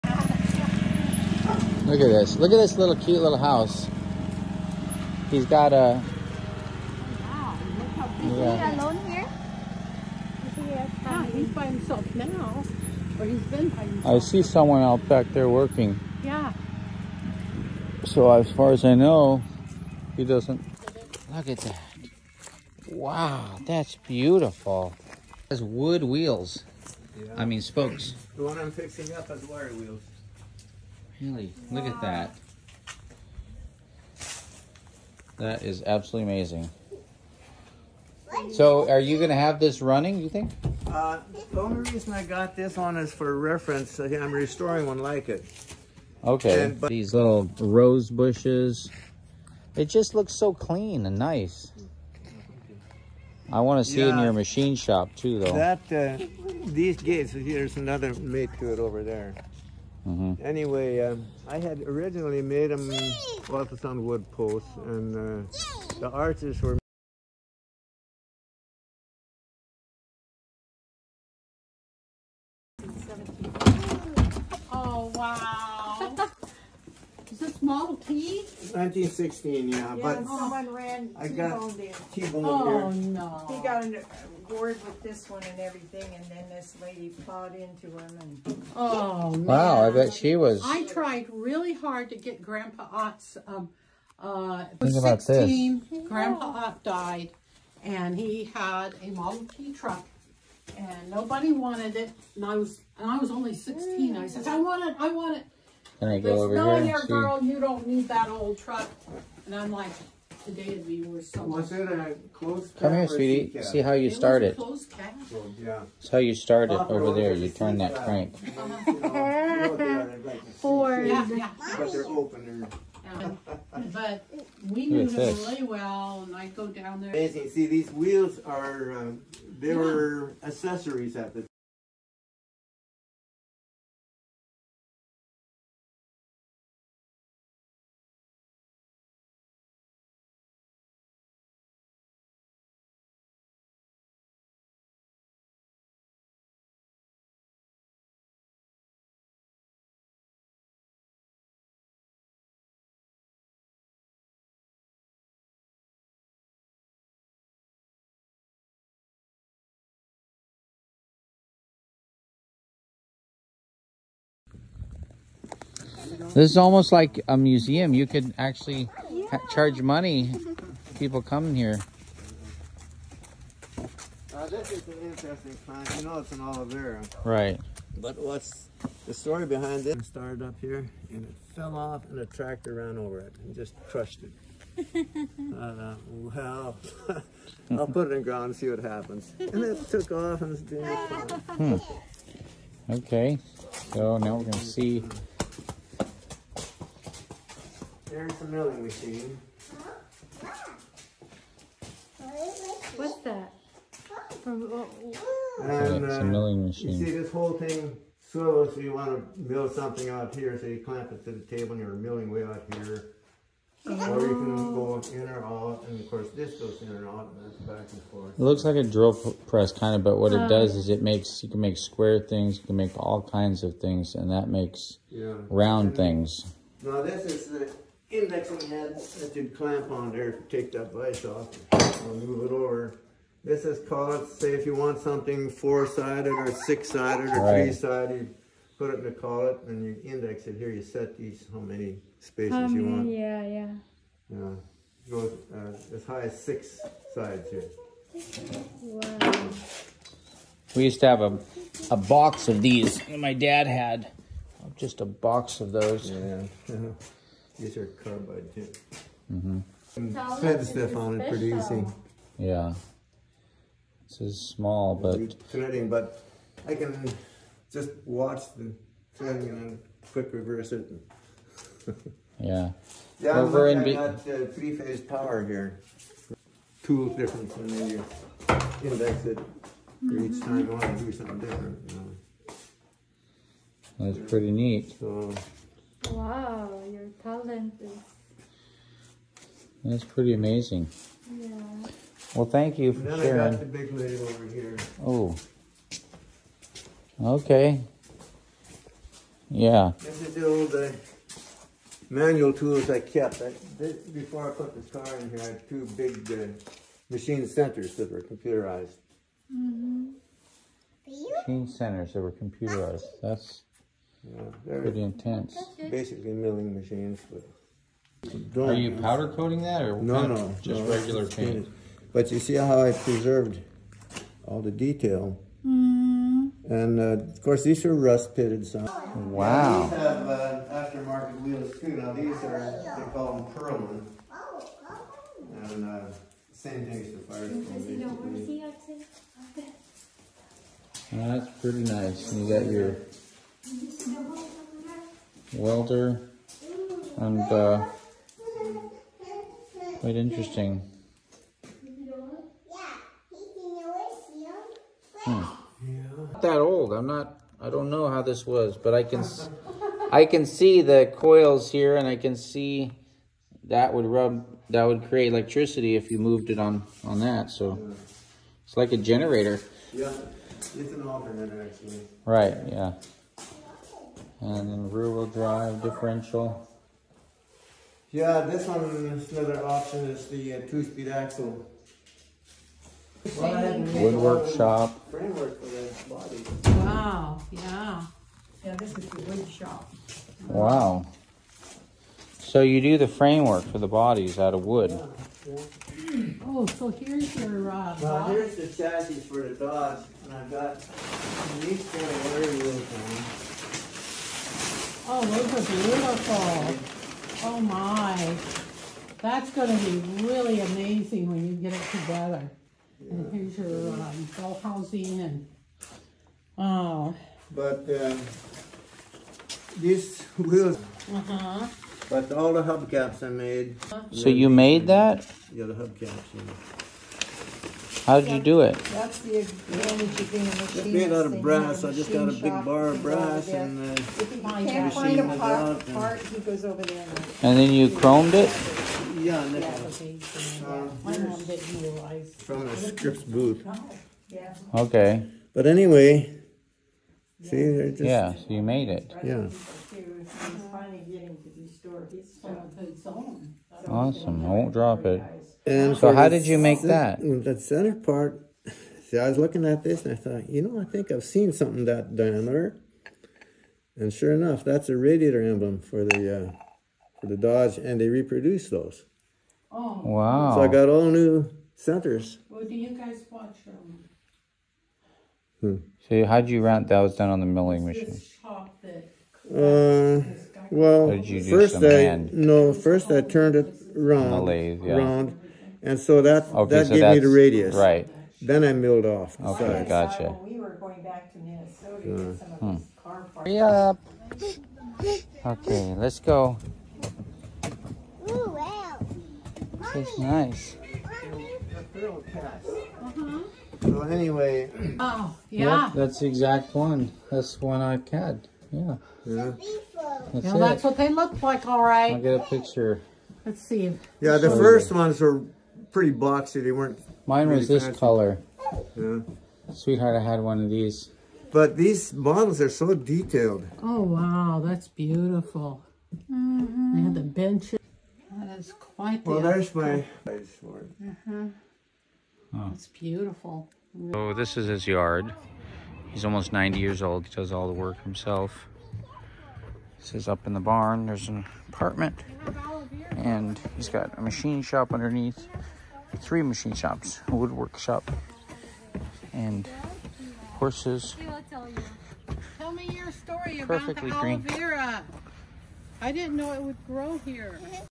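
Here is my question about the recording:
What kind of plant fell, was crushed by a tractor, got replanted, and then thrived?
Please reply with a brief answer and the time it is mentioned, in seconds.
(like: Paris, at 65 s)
aloe vera, at 176 s.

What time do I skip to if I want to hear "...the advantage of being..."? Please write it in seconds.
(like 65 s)
429 s.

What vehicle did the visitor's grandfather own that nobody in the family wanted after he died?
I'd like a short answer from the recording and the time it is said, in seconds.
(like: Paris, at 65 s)
Model T truck, at 99 s.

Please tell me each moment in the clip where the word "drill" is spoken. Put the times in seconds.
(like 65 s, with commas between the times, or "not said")
218 s.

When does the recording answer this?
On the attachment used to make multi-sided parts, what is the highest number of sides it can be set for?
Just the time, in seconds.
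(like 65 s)
246 s.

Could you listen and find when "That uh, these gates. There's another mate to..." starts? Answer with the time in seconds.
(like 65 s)
55 s.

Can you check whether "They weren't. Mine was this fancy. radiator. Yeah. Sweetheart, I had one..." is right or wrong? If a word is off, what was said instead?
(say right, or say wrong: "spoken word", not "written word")
wrong: "color", not "radiator".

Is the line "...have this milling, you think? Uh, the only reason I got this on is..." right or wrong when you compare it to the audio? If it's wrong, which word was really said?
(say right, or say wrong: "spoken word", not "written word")
wrong: "running", not "milling".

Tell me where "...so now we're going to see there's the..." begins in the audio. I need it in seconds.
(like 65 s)
193 s.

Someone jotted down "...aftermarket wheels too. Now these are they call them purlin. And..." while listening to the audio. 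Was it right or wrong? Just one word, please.
right.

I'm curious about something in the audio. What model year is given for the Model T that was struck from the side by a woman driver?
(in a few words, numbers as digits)
1916.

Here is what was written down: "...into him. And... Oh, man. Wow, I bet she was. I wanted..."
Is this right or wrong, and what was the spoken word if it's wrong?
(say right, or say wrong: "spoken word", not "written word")
wrong: "tried", not "wanted".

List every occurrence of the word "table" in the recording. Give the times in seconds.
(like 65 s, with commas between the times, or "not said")
211 s.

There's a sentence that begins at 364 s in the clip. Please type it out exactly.
That would create electricity if you moved it on on that.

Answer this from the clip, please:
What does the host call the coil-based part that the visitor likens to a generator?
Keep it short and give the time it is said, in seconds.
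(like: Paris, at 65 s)
alternator, at 371 s.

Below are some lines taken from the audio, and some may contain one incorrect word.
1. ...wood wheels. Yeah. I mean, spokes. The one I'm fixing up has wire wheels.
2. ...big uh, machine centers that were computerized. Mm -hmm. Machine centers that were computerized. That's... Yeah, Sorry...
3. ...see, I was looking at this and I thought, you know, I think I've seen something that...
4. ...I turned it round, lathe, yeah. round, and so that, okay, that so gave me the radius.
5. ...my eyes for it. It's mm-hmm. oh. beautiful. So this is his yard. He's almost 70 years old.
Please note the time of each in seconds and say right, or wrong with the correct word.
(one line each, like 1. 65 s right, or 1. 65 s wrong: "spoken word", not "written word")
1. 25 s right
2. 305 s wrong: "Pretty", not "Sorry"
3. 459 s right
4. 483 s right
5. 529 s wrong: "90", not "70".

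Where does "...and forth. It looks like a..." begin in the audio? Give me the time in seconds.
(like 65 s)
217 s.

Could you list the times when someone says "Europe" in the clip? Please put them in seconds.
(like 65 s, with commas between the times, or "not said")
not said.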